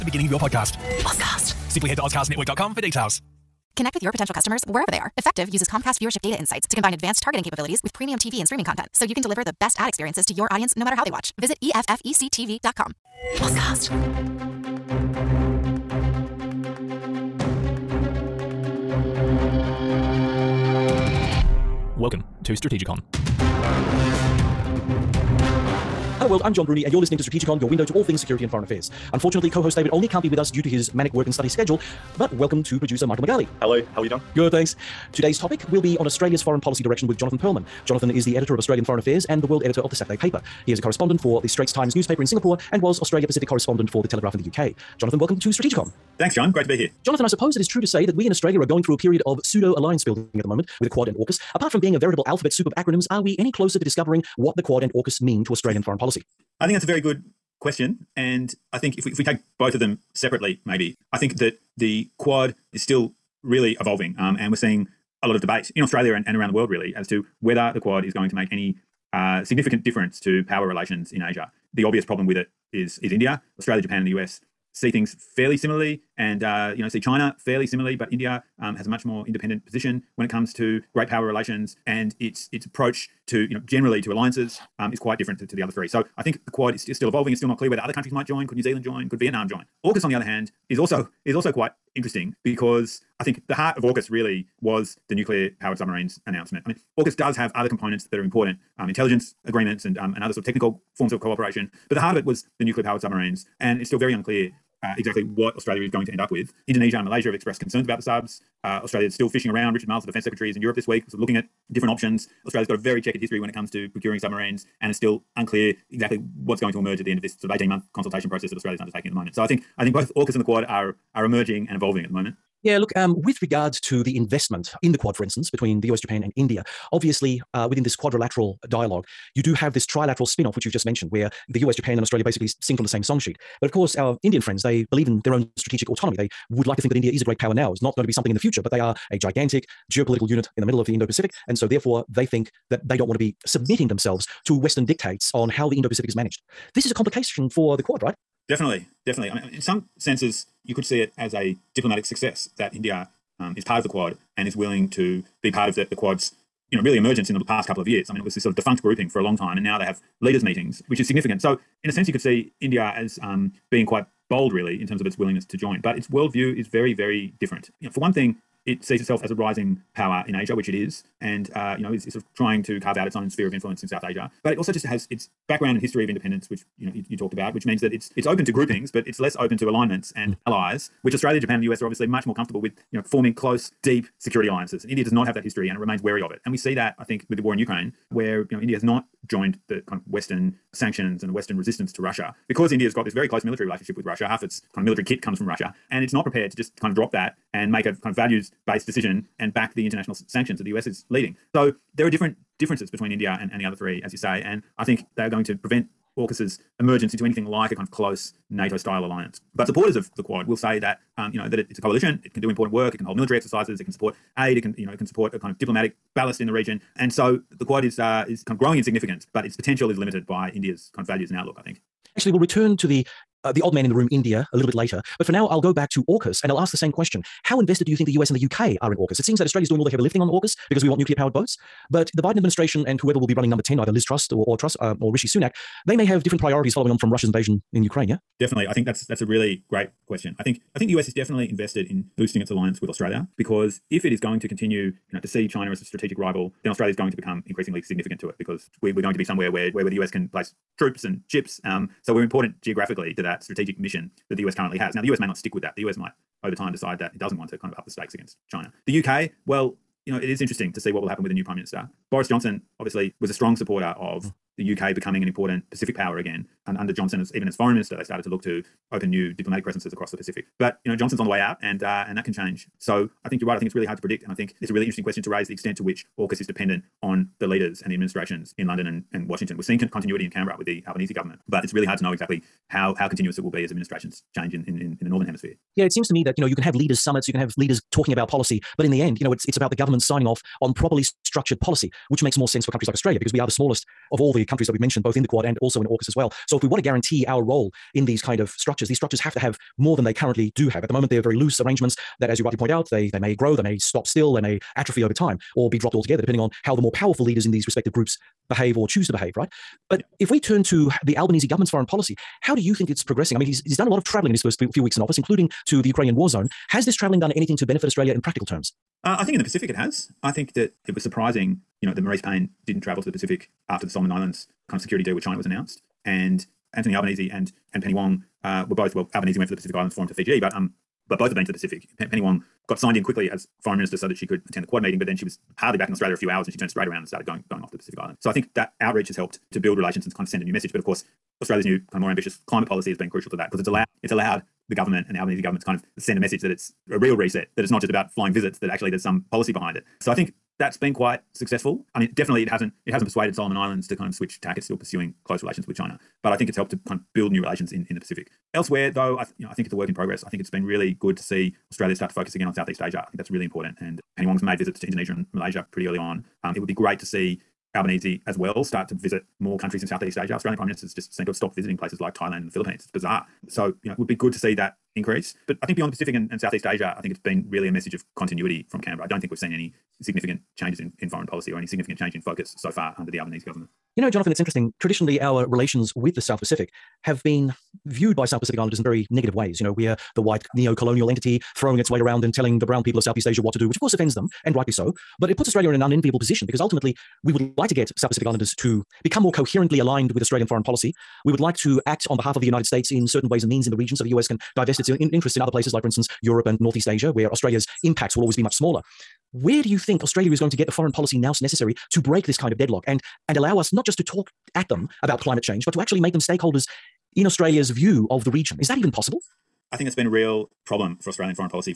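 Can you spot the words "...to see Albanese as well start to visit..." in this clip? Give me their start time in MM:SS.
06:06.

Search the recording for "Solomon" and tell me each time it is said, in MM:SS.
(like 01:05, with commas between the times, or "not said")
05:23, 05:53.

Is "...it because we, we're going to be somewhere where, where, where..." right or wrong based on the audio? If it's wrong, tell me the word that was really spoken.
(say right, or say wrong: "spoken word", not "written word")
right.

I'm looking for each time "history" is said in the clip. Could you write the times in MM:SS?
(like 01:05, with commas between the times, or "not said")
01:53, 02:55, 03:05.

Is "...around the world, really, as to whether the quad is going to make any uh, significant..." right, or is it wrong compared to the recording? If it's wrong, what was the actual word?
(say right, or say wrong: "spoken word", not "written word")
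right.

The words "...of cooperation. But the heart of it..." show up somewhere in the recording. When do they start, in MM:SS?
01:41.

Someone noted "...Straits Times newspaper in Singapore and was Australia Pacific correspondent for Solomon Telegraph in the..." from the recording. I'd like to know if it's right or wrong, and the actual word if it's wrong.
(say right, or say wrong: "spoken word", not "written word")
wrong: "The", not "Solomon".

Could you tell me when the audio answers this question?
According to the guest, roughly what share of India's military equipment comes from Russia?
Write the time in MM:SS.
03:14.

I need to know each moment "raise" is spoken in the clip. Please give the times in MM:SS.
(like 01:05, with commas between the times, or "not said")
04:35.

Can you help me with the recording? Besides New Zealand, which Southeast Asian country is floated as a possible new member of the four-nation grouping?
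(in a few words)
Vietnam.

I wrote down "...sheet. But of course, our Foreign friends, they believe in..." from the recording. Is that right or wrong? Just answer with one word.
wrong.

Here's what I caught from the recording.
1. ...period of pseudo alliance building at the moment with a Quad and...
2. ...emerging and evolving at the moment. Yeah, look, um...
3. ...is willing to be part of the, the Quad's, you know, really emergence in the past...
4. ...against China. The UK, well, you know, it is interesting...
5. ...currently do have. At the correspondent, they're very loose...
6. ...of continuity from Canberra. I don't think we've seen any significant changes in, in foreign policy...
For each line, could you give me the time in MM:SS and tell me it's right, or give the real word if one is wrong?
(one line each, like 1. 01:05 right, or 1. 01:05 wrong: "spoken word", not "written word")
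1. 00:48 right
2. 02:01 right
3. 02:34 right
4. 04:18 right
5. 05:00 wrong: "moment", not "correspondent"
6. 06:17 right.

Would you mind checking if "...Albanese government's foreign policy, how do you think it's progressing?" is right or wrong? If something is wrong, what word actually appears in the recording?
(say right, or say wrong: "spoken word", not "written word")
right.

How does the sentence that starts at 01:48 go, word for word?
Uh, Australia is still fishing around.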